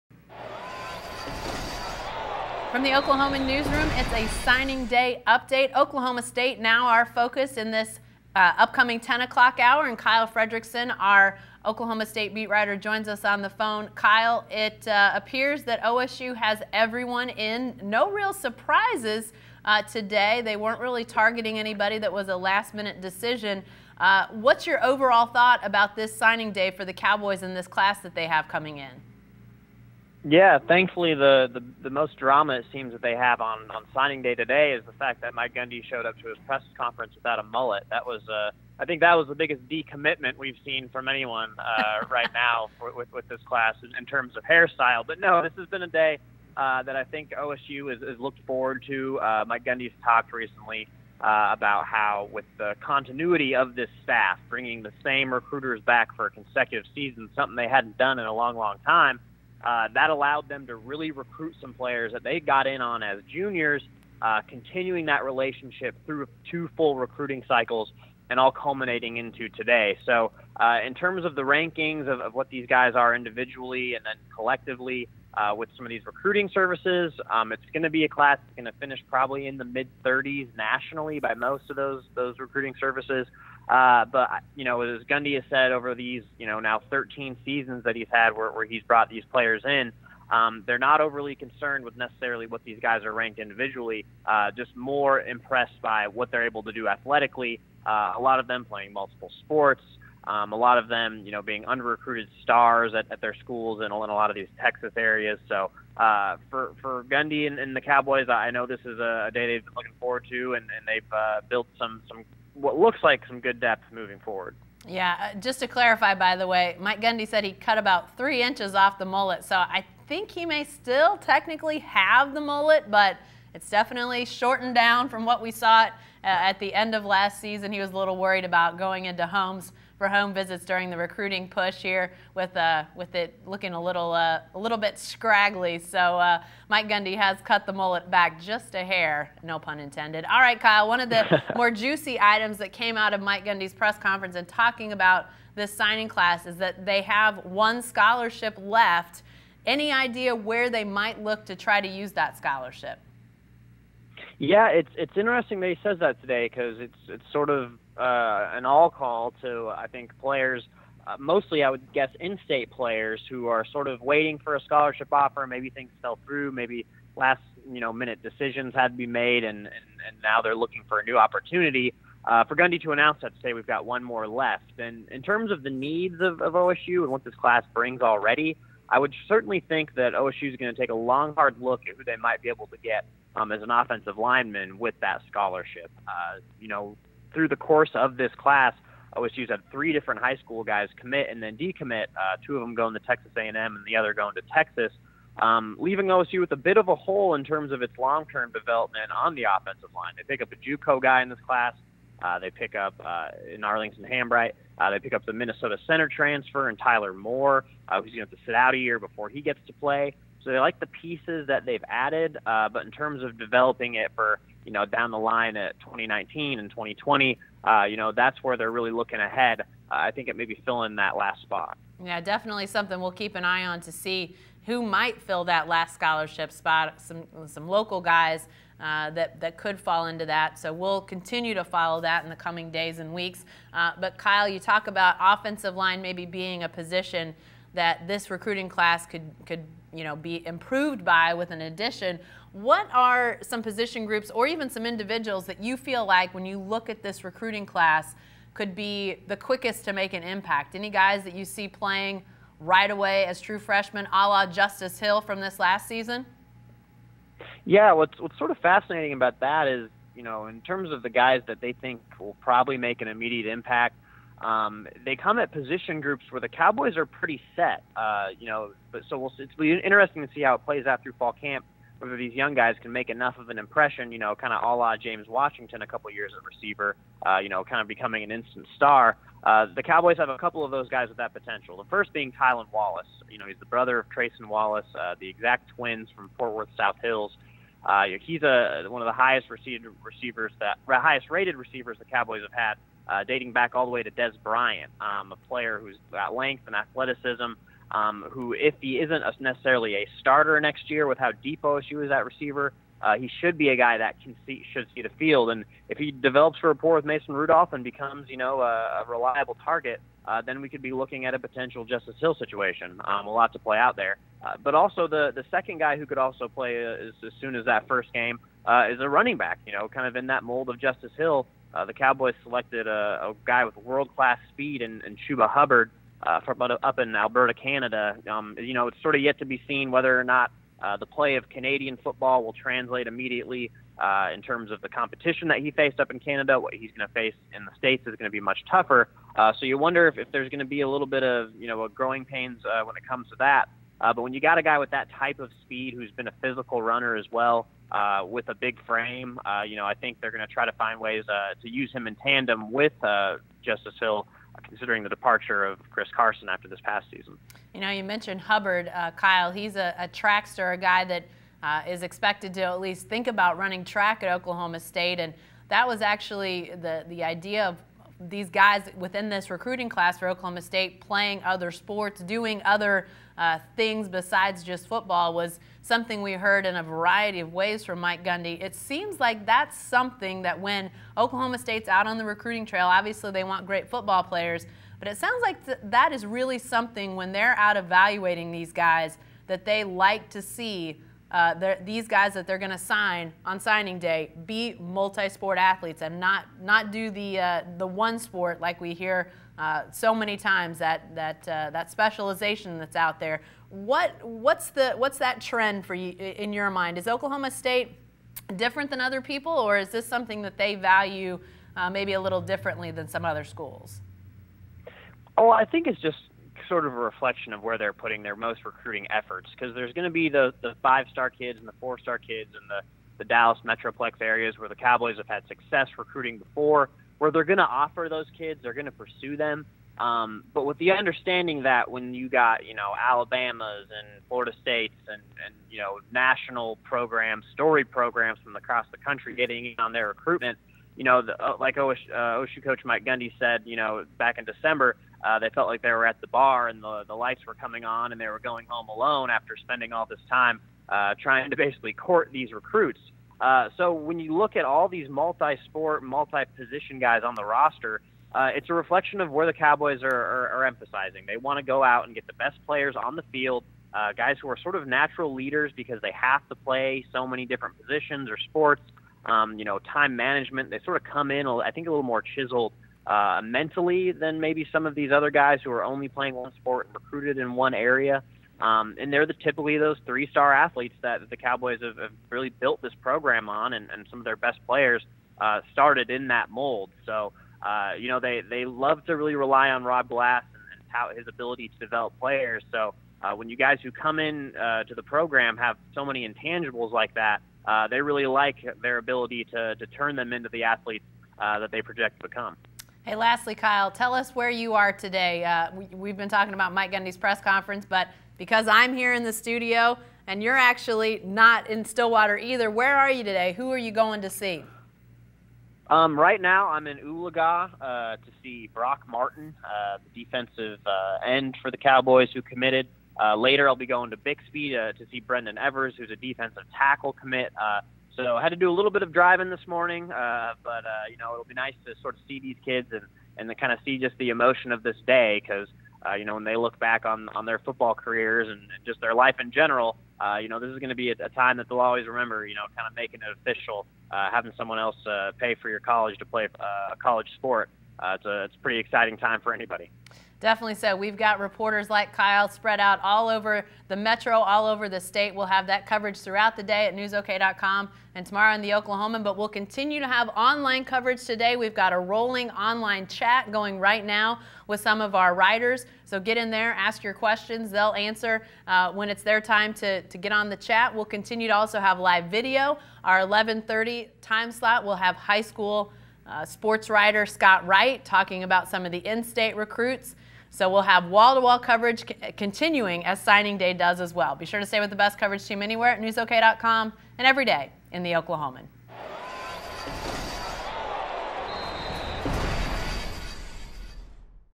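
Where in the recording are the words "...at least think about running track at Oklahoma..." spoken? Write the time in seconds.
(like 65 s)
362 s.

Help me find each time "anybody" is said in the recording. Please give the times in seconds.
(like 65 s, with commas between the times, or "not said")
21 s, 549 s.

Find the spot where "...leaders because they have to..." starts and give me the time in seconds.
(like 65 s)
465 s.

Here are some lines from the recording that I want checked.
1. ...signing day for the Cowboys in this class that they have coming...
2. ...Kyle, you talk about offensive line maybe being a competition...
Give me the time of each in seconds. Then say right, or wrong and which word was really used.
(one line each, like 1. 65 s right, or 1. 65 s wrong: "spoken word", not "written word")
1. 26 s right
2. 234 s wrong: "position", not "competition".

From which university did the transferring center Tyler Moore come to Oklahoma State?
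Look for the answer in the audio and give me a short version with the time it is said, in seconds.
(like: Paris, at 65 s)
Minnesota, at 205 s.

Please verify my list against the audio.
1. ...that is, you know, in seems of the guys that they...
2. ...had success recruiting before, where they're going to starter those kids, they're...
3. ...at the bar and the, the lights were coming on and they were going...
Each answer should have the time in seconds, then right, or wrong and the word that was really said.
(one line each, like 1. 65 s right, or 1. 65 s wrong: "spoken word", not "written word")
1. 259 s wrong: "terms", not "seems"
2. 425 s wrong: "offer", not "starter"
3. 446 s right.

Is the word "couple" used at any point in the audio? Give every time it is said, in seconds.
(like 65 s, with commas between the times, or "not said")
275 s, 280 s.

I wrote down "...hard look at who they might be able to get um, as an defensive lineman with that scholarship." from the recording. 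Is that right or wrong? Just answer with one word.
wrong.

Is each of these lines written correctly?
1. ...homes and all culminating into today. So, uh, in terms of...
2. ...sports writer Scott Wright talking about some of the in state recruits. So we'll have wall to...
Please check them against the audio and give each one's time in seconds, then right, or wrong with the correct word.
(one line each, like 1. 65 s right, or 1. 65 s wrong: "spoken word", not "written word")
1. 67 s wrong: "cycles", not "homes"
2. 576 s right.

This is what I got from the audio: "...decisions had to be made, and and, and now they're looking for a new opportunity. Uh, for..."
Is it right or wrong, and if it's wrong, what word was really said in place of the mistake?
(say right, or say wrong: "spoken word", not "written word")
right.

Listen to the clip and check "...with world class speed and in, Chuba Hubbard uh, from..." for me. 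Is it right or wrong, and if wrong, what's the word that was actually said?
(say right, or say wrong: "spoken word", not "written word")
right.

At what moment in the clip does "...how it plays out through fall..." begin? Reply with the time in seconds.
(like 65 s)
270 s.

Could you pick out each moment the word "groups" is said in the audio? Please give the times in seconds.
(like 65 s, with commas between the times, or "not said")
244 s, 266 s.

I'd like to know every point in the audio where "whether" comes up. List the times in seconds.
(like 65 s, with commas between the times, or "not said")
271 s, 329 s.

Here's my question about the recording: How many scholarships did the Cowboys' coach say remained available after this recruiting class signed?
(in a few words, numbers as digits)
1.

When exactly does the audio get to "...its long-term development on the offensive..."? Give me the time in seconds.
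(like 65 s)
197 s.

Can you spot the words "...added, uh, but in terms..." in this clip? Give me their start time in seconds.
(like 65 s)
211 s.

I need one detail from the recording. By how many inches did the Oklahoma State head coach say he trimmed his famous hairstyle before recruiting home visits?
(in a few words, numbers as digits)
3.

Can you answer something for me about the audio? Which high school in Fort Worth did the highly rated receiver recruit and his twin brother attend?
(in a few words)
South Hills.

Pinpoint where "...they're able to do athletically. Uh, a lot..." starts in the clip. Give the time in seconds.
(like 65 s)
96 s.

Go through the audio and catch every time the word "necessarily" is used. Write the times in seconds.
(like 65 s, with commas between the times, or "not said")
91 s, 299 s.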